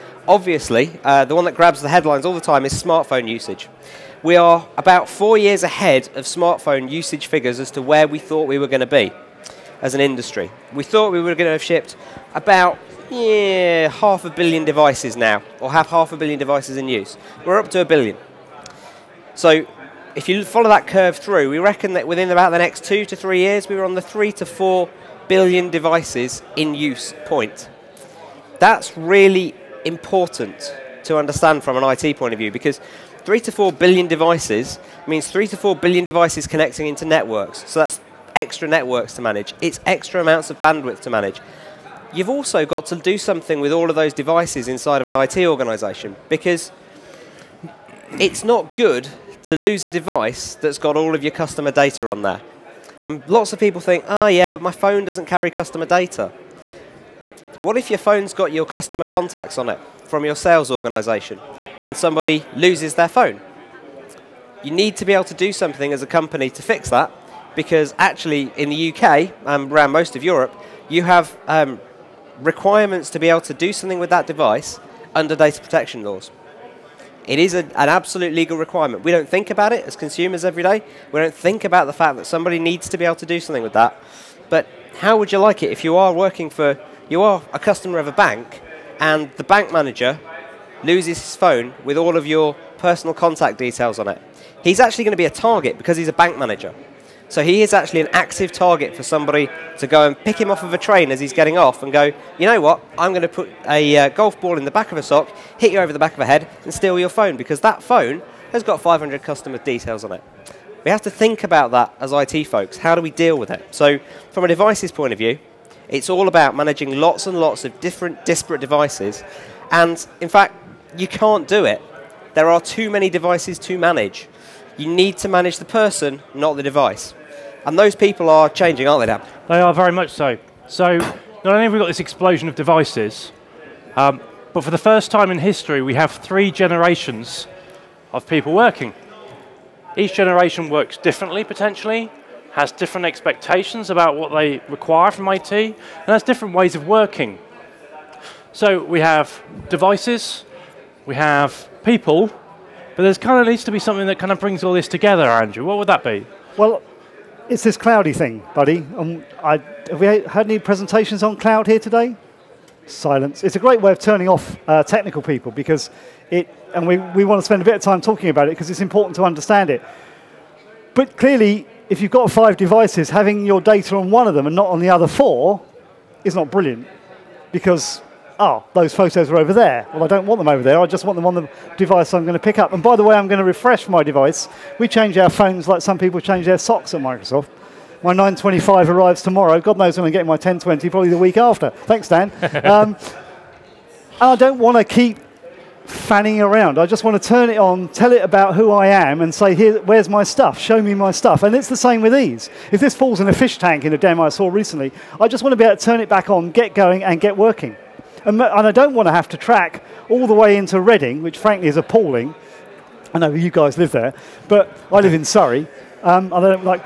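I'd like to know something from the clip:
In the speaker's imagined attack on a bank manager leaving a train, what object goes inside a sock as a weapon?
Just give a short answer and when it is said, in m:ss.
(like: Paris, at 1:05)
golf ball, at 1:44.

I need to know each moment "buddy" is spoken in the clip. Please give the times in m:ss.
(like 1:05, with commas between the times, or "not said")
2:38.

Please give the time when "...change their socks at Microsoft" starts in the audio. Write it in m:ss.
3:06.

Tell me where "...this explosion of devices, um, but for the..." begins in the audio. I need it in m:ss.
2:11.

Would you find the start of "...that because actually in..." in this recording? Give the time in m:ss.
1:06.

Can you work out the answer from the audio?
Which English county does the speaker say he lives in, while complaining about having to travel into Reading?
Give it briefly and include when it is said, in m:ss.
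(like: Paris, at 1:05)
Surrey, at 3:35.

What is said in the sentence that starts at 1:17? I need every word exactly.
It is a, an absolute legal requirement.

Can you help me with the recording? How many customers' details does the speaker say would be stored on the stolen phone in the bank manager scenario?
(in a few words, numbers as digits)
500.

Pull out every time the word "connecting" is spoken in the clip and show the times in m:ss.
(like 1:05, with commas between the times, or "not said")
0:36.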